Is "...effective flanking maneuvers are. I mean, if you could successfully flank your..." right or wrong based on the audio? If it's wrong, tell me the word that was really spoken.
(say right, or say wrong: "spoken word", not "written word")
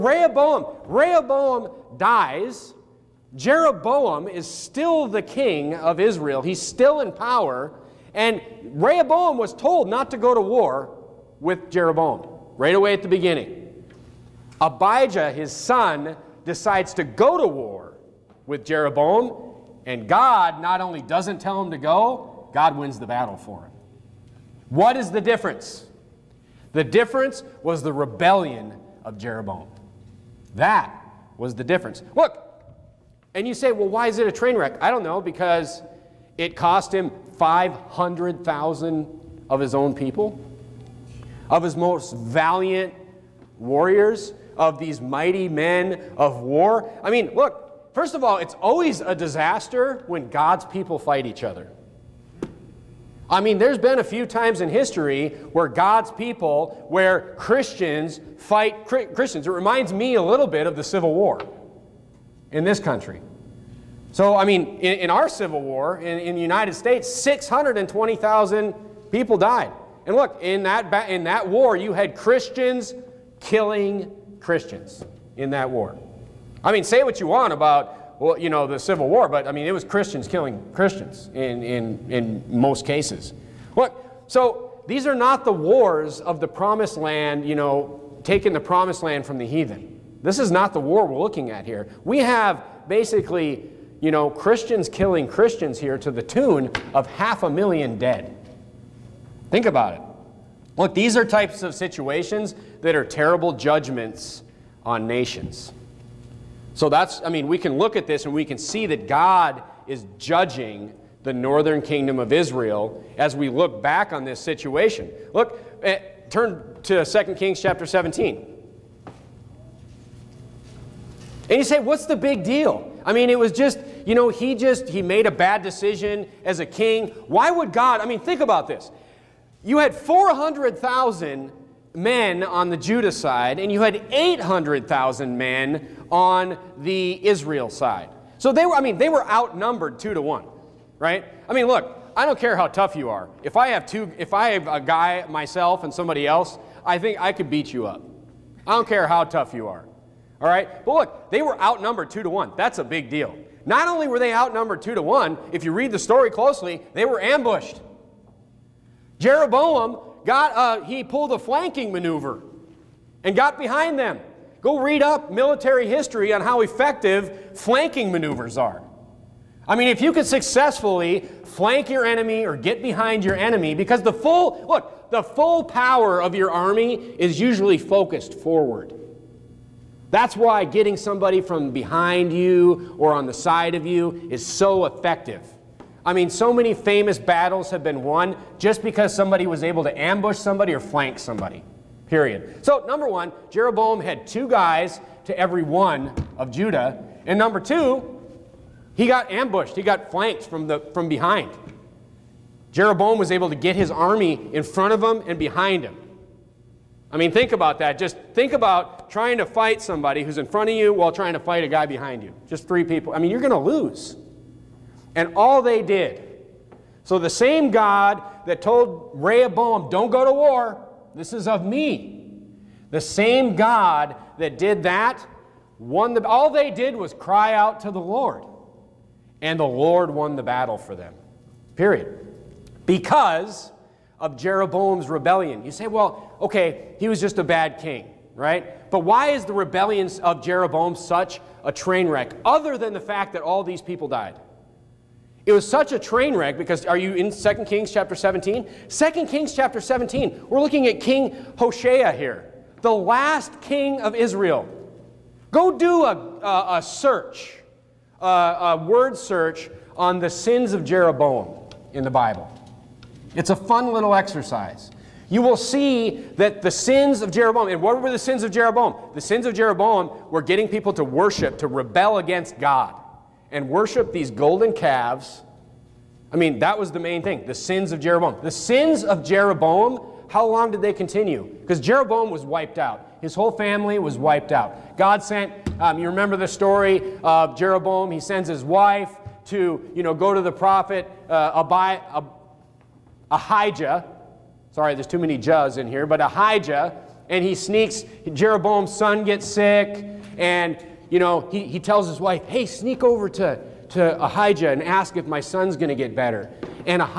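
right.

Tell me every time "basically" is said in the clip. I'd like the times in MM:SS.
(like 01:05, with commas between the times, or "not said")
01:32.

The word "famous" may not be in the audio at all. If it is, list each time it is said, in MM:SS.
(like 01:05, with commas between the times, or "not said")
03:06.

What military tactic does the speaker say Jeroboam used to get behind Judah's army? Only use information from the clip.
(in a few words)
Flanking maneuver.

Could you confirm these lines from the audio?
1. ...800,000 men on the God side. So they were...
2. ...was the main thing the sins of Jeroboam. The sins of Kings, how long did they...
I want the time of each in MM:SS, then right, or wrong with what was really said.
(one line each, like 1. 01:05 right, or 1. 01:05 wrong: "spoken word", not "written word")
1. 02:14 wrong: "Israel", not "God"
2. 04:36 wrong: "Jeroboam", not "Kings".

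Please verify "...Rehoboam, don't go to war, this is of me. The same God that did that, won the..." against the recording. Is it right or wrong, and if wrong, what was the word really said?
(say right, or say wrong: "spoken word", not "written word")
right.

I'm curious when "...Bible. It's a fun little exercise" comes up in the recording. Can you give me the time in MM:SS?
04:22.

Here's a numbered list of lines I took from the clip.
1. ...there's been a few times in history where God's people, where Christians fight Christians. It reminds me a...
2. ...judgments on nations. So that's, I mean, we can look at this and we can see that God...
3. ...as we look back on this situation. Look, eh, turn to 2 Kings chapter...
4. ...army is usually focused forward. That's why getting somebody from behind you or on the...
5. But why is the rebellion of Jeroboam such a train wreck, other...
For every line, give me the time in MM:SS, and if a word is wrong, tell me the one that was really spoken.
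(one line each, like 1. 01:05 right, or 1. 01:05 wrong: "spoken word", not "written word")
1. 00:53 right
2. 01:43 right
3. 01:53 right
4. 02:56 right
5. 03:58 right.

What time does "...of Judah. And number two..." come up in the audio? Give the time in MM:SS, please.
03:16.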